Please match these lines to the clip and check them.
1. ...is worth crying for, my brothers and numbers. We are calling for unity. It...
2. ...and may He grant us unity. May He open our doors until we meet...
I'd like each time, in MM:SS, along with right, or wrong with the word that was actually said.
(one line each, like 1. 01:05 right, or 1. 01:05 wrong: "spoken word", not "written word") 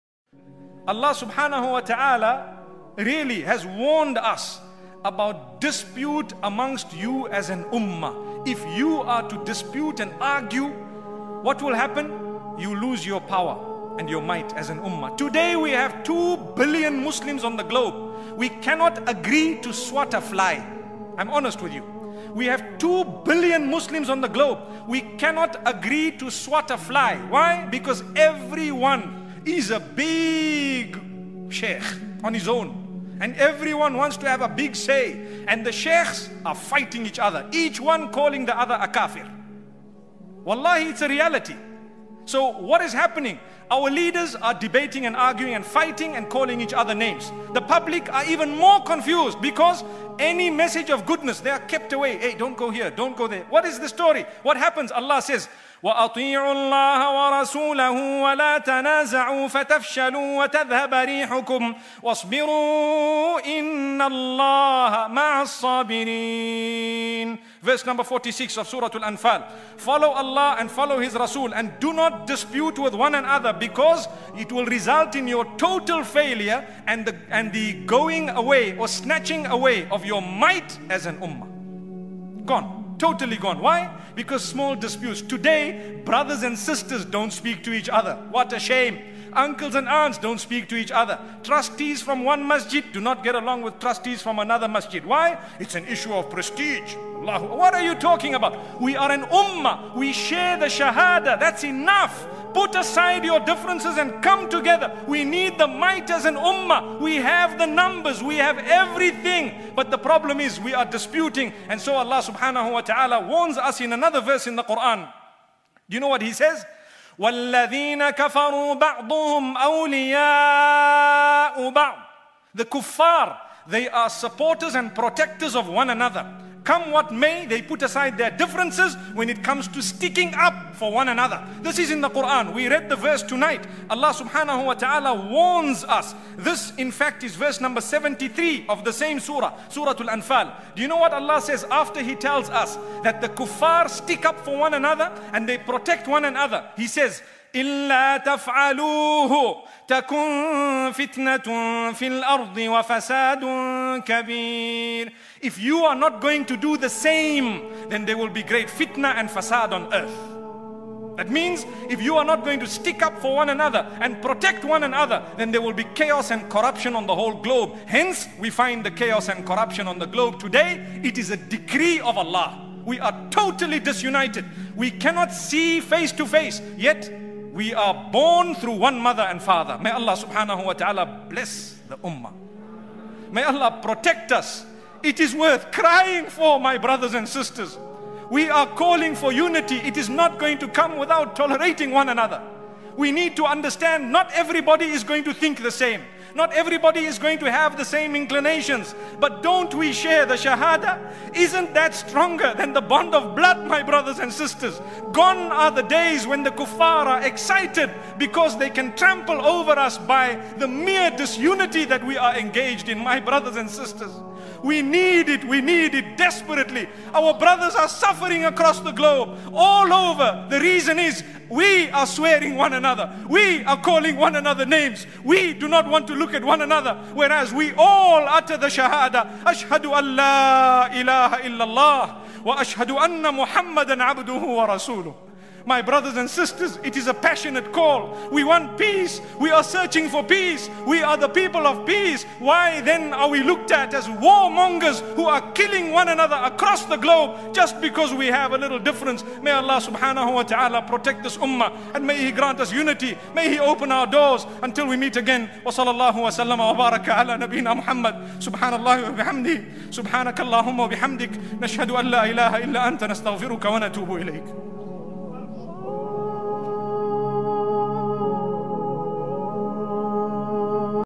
1. 03:05 wrong: "sisters", not "numbers"
2. 04:11 right.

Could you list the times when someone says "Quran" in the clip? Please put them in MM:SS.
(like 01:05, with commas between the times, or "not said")
01:54, 02:12.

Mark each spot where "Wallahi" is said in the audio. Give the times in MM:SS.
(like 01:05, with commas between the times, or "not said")
00:40.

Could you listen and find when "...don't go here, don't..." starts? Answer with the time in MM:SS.
00:52.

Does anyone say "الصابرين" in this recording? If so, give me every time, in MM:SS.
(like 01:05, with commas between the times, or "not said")
01:05.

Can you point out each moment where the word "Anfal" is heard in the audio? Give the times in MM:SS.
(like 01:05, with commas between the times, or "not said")
01:09, 02:20.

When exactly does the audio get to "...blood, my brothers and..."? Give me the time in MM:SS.
03:23.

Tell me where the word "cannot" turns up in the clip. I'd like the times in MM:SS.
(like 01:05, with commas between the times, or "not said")
00:18, 00:25, 02:54.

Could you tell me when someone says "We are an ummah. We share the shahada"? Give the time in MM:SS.
01:38.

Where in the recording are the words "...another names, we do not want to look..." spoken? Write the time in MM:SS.
03:44.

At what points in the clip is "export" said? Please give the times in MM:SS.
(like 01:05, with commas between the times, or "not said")
not said.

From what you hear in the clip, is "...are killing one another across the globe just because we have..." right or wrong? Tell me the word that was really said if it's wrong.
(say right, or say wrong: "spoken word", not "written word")
right.